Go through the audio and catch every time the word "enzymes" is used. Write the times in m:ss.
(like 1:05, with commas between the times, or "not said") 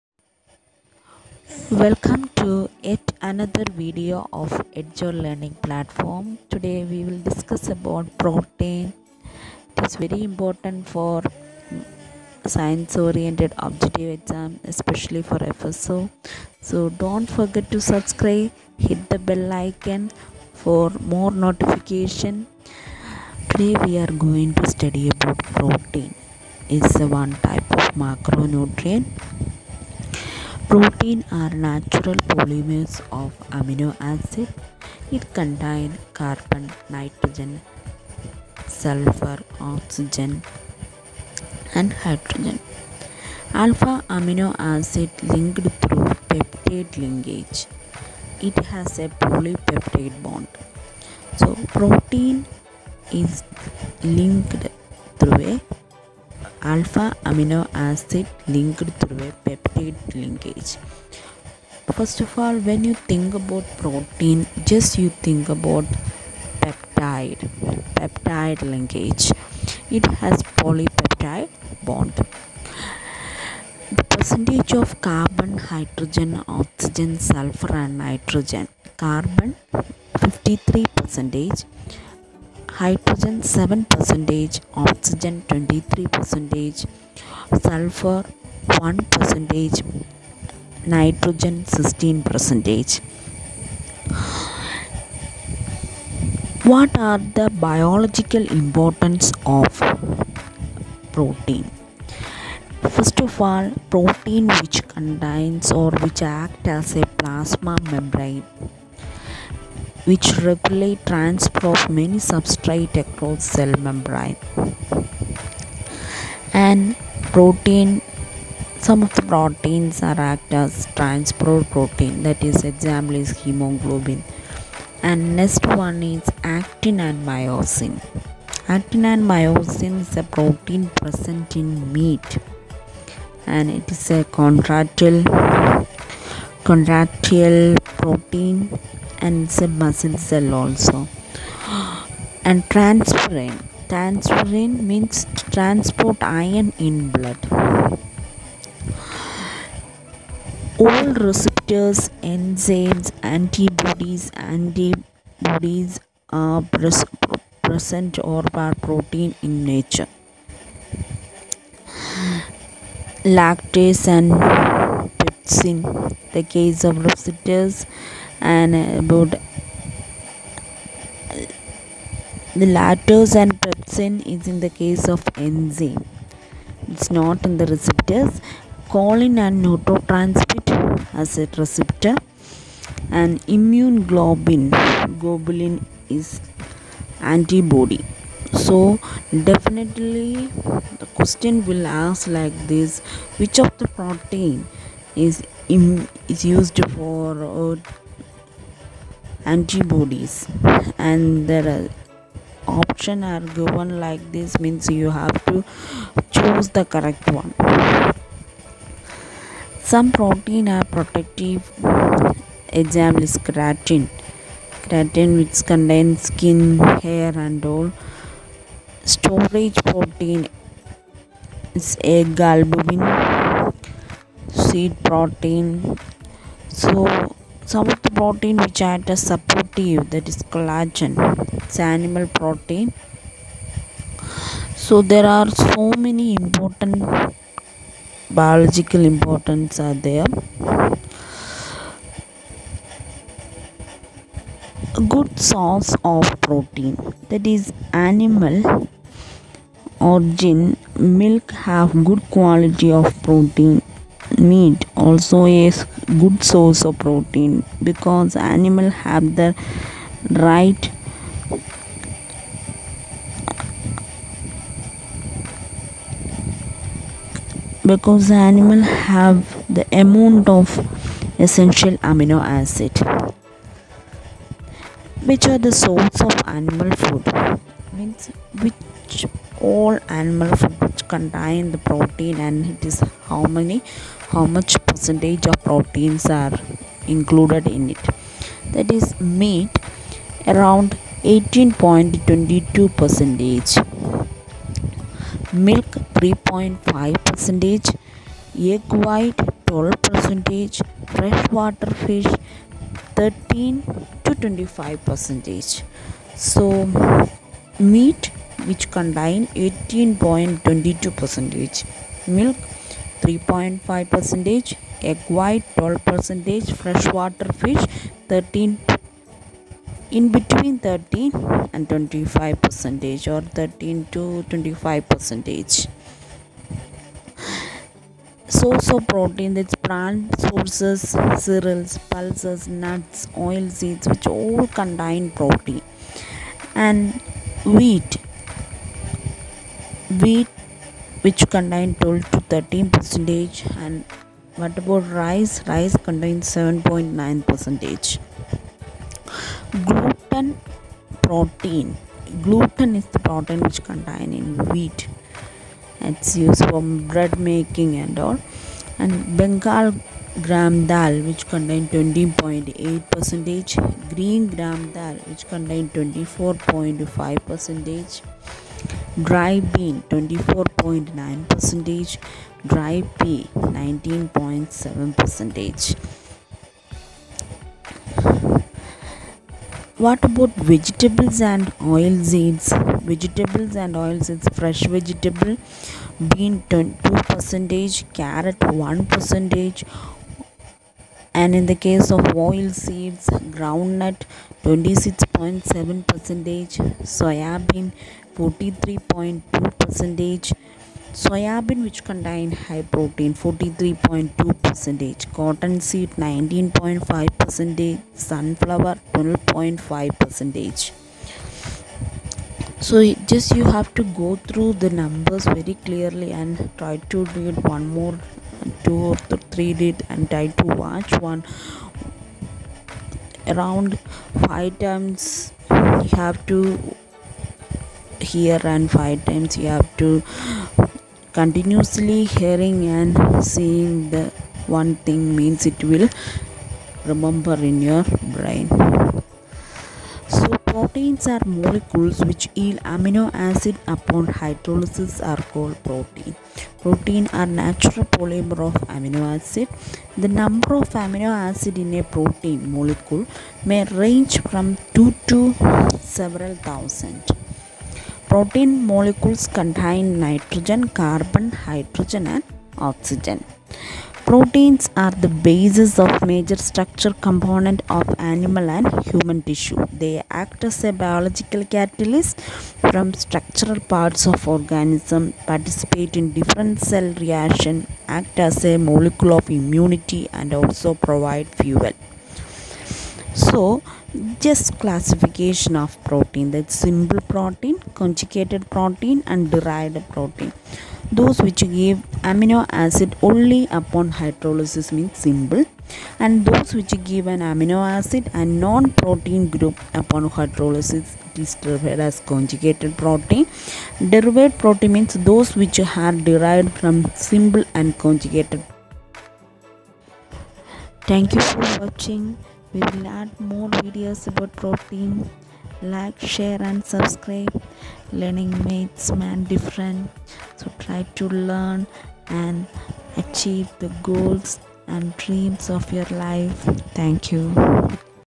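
2:32, 2:55.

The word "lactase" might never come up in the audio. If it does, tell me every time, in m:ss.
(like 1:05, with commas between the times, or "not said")
2:43, 2:52.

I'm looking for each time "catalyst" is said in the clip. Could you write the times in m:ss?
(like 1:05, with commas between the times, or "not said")
7:51.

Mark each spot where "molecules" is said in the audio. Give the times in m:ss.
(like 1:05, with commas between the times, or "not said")
7:21, 7:32, 7:38, 7:58.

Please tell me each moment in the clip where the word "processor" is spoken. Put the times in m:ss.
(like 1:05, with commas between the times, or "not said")
not said.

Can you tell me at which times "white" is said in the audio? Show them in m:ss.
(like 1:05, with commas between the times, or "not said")
4:59, 5:15.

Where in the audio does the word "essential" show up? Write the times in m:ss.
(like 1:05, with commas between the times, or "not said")
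4:31.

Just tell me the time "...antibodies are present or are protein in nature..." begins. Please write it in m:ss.
2:34.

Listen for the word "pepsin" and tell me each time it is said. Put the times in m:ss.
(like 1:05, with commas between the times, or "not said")
2:45, 2:53.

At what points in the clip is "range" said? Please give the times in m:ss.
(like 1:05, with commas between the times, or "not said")
7:33.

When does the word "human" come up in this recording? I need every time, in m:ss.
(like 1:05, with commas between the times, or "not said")
7:49.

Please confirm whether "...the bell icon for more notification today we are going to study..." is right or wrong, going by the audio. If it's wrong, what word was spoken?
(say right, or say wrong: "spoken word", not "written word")
right.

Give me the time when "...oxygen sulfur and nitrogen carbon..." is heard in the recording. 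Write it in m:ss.
1:16.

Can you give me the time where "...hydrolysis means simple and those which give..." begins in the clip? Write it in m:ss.
8:14.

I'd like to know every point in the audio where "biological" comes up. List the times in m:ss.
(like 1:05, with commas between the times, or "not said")
1:37, 3:58, 7:50.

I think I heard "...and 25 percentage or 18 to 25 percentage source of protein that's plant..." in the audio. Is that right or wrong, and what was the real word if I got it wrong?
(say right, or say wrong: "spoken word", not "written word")
wrong: "13", not "18".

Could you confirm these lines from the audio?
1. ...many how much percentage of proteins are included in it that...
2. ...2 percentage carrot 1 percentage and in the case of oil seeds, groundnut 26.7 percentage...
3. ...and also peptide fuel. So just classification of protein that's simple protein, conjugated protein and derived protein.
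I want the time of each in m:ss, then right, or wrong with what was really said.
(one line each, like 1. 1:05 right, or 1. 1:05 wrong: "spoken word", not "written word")
1. 4:43 right
2. 6:26 right
3. 8:00 wrong: "provide", not "peptide".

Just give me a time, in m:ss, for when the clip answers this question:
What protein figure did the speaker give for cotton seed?
6:45.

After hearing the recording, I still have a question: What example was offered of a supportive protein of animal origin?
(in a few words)
Collagen.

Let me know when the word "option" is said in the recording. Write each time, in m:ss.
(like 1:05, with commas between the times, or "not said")
3:22.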